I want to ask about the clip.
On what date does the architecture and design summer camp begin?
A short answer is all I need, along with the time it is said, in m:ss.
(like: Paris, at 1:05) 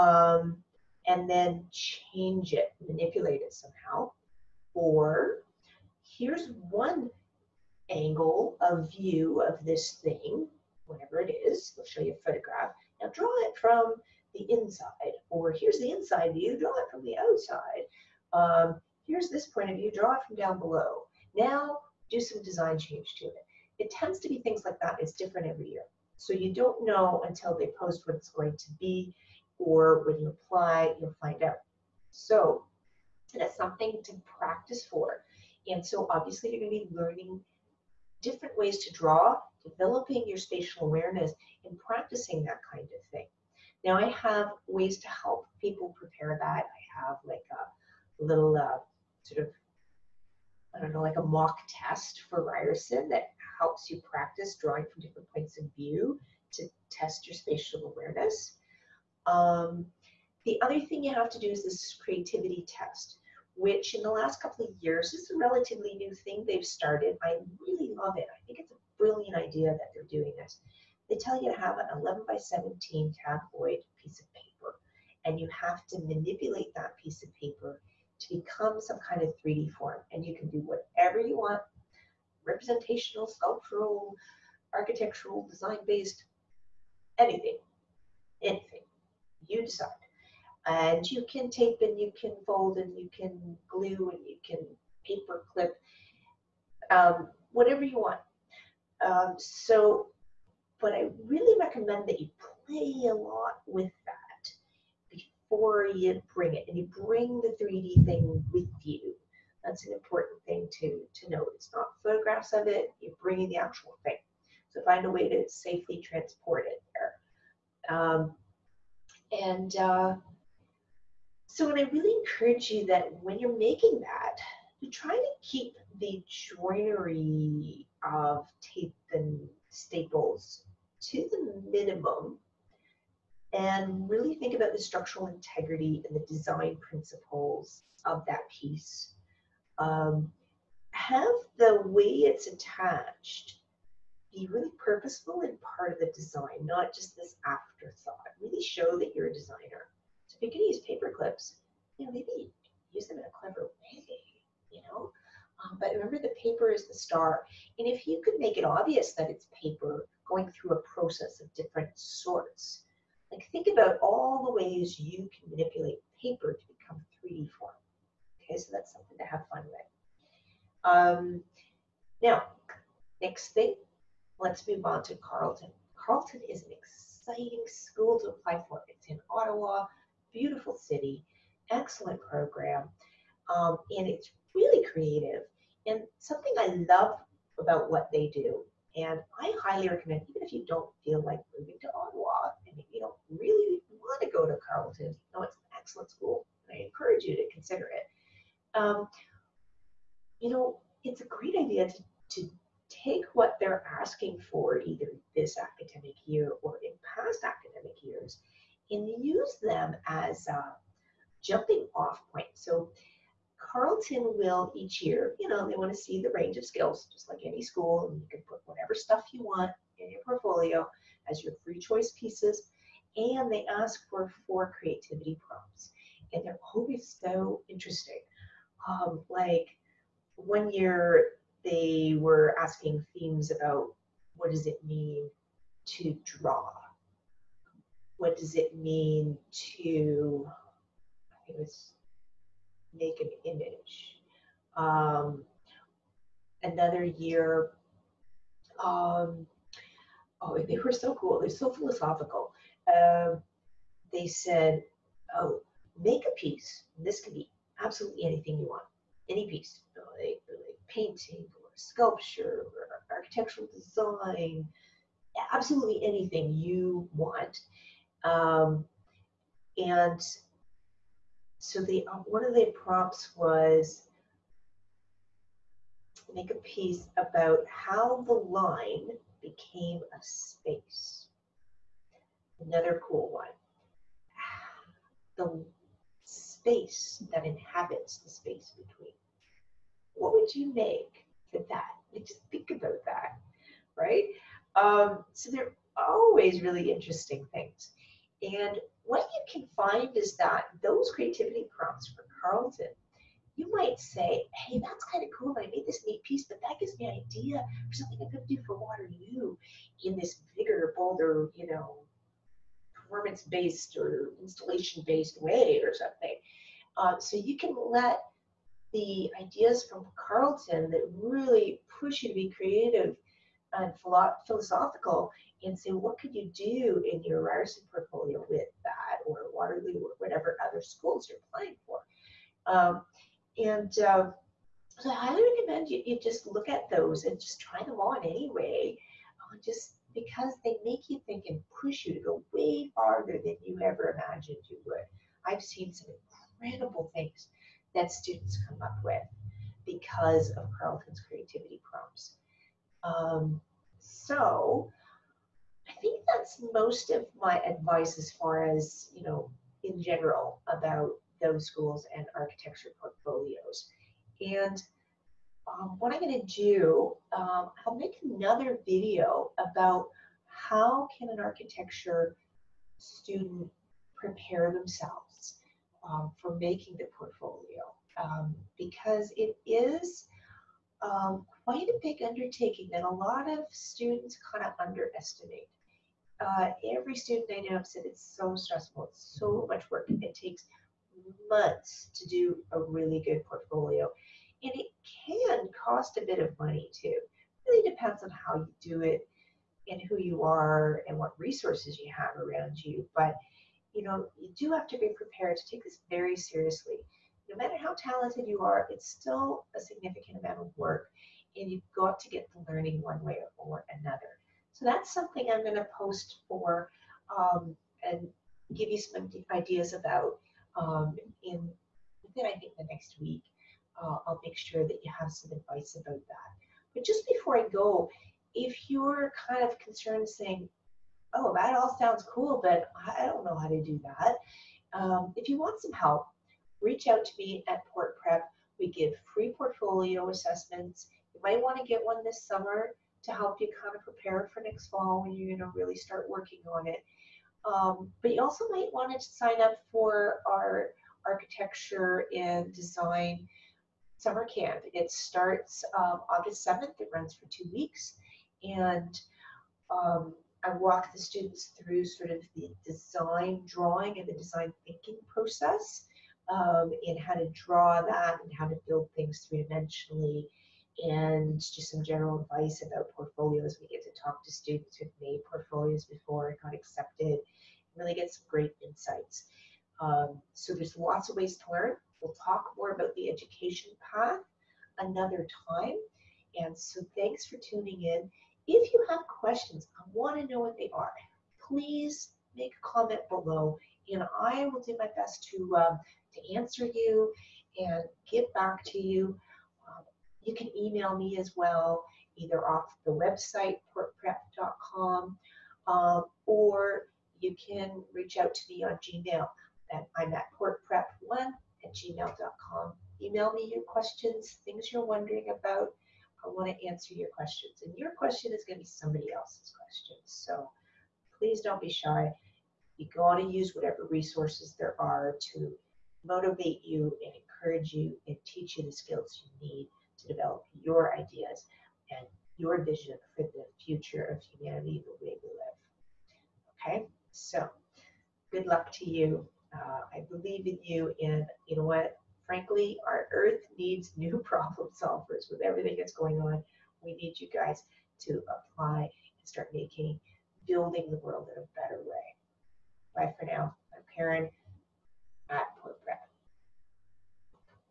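August 7, at 7:36.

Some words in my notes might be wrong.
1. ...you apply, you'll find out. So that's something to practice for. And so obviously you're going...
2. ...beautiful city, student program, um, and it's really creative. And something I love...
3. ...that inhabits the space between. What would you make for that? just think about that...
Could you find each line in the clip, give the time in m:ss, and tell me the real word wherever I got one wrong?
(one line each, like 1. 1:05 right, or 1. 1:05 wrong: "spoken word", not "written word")
1. 0:30 right
2. 3:00 wrong: "excellent", not "student"
3. 4:47 right.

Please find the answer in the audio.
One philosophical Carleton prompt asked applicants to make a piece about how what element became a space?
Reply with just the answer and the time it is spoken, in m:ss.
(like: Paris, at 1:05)
the line, at 4:38.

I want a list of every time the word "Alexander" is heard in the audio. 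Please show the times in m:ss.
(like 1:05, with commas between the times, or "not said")
not said.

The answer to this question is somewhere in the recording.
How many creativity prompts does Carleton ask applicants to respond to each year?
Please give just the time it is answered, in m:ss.
3:44.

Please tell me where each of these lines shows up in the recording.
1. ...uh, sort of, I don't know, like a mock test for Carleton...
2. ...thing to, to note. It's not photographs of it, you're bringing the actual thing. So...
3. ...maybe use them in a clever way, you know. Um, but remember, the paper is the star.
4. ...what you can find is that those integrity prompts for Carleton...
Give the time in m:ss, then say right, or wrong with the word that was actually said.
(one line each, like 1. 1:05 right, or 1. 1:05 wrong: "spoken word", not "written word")
1. 0:48 wrong: "Ryerson", not "Carleton"
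2. 1:50 right
3. 2:32 right
4. 4:59 wrong: "creativity", not "integrity".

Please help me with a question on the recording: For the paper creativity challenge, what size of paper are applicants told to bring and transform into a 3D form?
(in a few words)
11 by 17.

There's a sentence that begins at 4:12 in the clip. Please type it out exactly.
Uh, they said, oh, make a piece.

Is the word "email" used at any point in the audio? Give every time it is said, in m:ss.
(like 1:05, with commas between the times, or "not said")
8:20, 8:33.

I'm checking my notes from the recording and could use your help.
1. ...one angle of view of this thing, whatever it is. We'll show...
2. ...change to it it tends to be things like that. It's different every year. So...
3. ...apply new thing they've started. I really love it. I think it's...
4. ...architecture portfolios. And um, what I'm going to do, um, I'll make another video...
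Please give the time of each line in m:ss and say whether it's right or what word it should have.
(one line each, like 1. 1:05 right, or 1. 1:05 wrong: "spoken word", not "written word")
1. 0:06 right
2. 0:22 right
3. 1:05 wrong: "relatively", not "apply"
4. 6:02 right.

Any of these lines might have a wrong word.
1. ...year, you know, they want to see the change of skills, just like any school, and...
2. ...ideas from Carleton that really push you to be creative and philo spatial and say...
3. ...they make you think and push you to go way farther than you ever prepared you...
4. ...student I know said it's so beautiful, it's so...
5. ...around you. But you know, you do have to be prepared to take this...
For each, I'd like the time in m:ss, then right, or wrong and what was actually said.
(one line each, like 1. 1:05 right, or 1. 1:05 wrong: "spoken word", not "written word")
1. 3:35 wrong: "range", not "change"
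2. 5:19 wrong: "philosophical", not "spatial"
3. 5:40 wrong: "imagined", not "prepared"
4. 6:27 wrong: "stressful", not "beautiful"
5. 6:42 right.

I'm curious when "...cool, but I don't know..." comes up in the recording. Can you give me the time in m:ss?
7:12.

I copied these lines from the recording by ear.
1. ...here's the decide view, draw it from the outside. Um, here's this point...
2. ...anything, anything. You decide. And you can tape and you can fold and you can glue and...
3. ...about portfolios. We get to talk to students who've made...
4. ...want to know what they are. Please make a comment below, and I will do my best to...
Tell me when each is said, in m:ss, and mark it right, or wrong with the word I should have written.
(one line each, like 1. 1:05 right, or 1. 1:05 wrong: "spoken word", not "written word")
1. 0:15 wrong: "inside", not "decide"
2. 1:27 right
3. 7:52 right
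4. 8:10 right.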